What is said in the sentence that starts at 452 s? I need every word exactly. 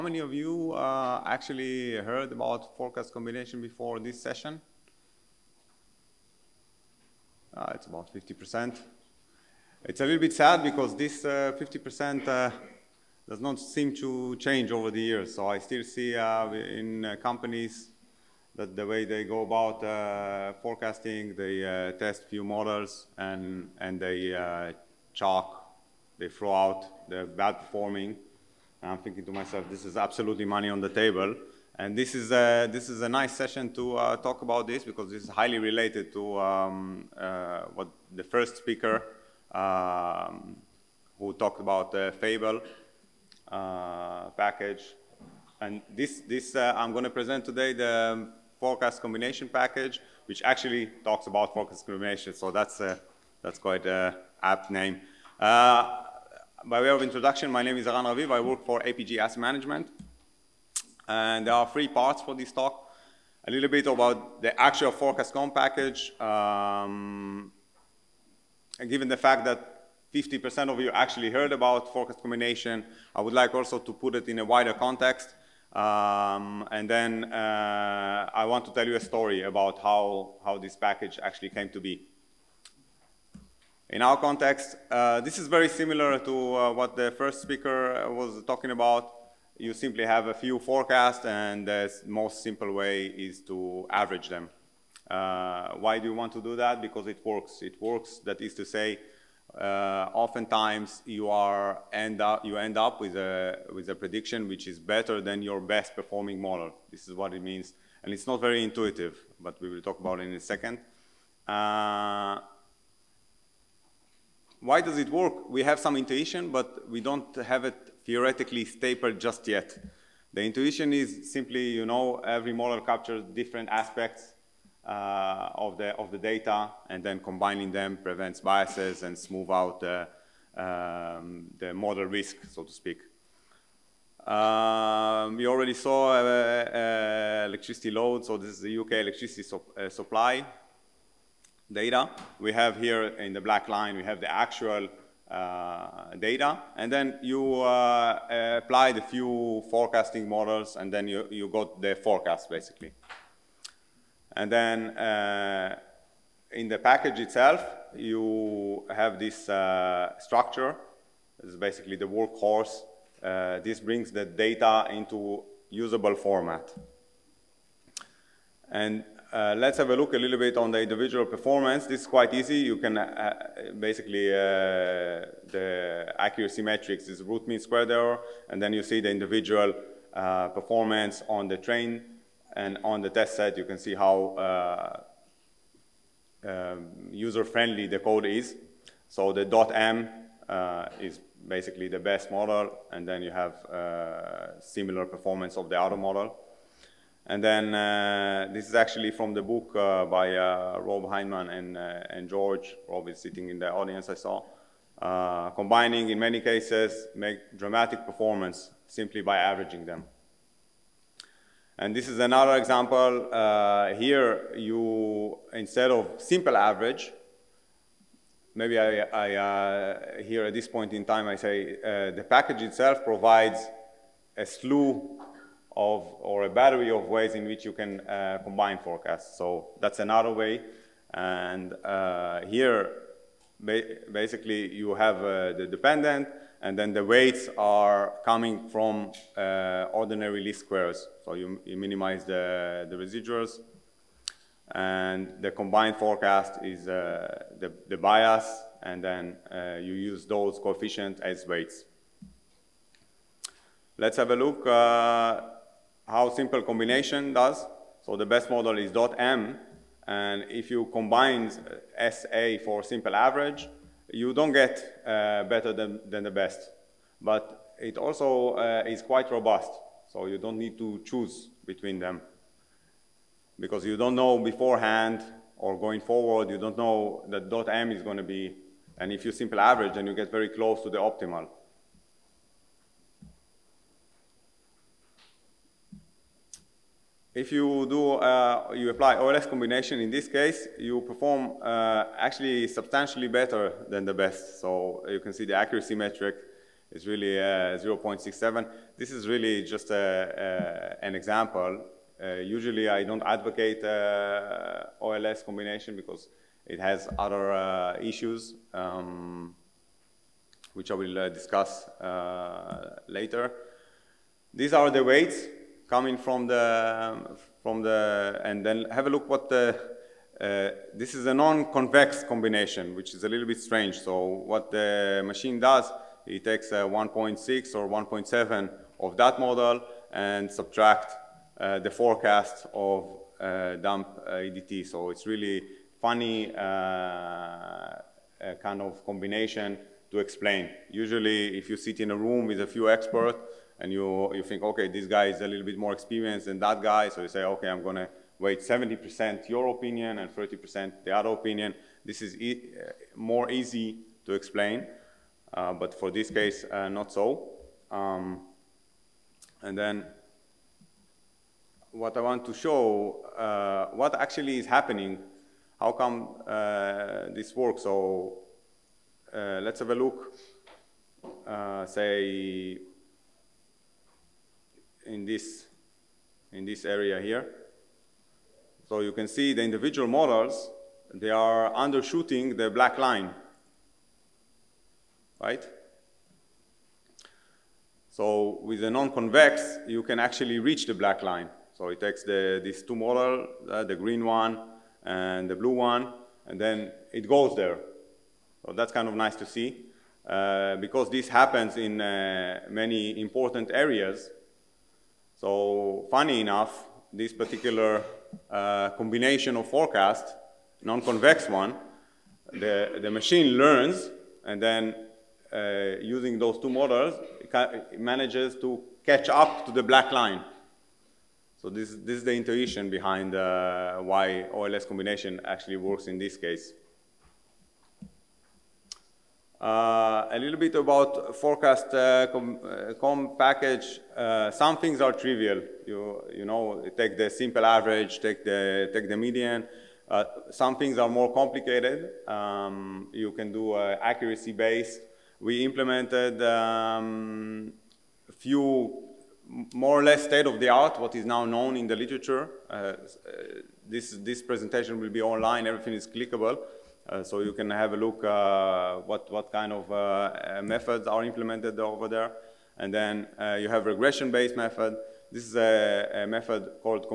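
Uh, this, this presentation will be online, everything is clickable.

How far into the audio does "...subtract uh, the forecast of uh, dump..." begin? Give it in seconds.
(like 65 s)
330 s.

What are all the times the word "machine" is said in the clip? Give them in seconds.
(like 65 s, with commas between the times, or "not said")
325 s, 413 s.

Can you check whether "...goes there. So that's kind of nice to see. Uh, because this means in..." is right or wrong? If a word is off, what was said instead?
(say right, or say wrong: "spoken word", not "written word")
wrong: "happens", not "means".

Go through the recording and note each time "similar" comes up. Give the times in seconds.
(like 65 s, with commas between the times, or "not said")
85 s, 194 s.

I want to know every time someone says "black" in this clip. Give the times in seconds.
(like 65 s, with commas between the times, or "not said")
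143 s, 382 s, 390 s, 419 s.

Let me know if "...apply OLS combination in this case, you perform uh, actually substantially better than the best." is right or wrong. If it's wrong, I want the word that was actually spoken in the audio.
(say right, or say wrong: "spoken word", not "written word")
right.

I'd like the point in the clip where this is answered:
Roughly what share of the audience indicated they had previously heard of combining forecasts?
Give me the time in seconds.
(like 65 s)
7 s.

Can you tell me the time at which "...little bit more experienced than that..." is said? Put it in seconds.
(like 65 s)
345 s.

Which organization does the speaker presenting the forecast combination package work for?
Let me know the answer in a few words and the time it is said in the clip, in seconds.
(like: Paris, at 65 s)
APG Asset Management, at 58 s.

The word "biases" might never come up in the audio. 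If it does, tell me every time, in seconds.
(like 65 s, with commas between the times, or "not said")
128 s.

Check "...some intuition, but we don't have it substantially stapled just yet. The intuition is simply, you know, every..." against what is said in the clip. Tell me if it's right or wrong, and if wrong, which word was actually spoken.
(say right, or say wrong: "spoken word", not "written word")
wrong: "theoretically", not "substantially".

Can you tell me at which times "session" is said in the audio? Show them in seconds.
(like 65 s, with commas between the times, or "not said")
4 s, 33 s.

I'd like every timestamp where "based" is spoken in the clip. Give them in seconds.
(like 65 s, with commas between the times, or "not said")
444 s, 463 s.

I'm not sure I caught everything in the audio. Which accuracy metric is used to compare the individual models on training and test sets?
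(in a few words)
Root mean squared error.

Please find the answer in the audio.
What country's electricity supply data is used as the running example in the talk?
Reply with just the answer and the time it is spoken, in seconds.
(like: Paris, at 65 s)
UK, at 138 s.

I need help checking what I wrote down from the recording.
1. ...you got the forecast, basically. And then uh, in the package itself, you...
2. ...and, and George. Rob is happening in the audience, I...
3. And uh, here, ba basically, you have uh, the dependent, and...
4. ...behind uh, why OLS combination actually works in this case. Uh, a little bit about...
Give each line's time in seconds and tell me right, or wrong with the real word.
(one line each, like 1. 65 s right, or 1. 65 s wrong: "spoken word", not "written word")
1. 151 s right
2. 201 s wrong: "sitting", not "happening"
3. 231 s right
4. 422 s right.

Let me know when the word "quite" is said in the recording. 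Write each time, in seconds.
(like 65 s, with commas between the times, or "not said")
53 s, 172 s, 269 s.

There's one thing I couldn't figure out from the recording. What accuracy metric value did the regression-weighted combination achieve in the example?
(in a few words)
0.67.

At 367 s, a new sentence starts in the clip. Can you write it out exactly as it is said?
So uh, let's have a look, say, in this, in this area here.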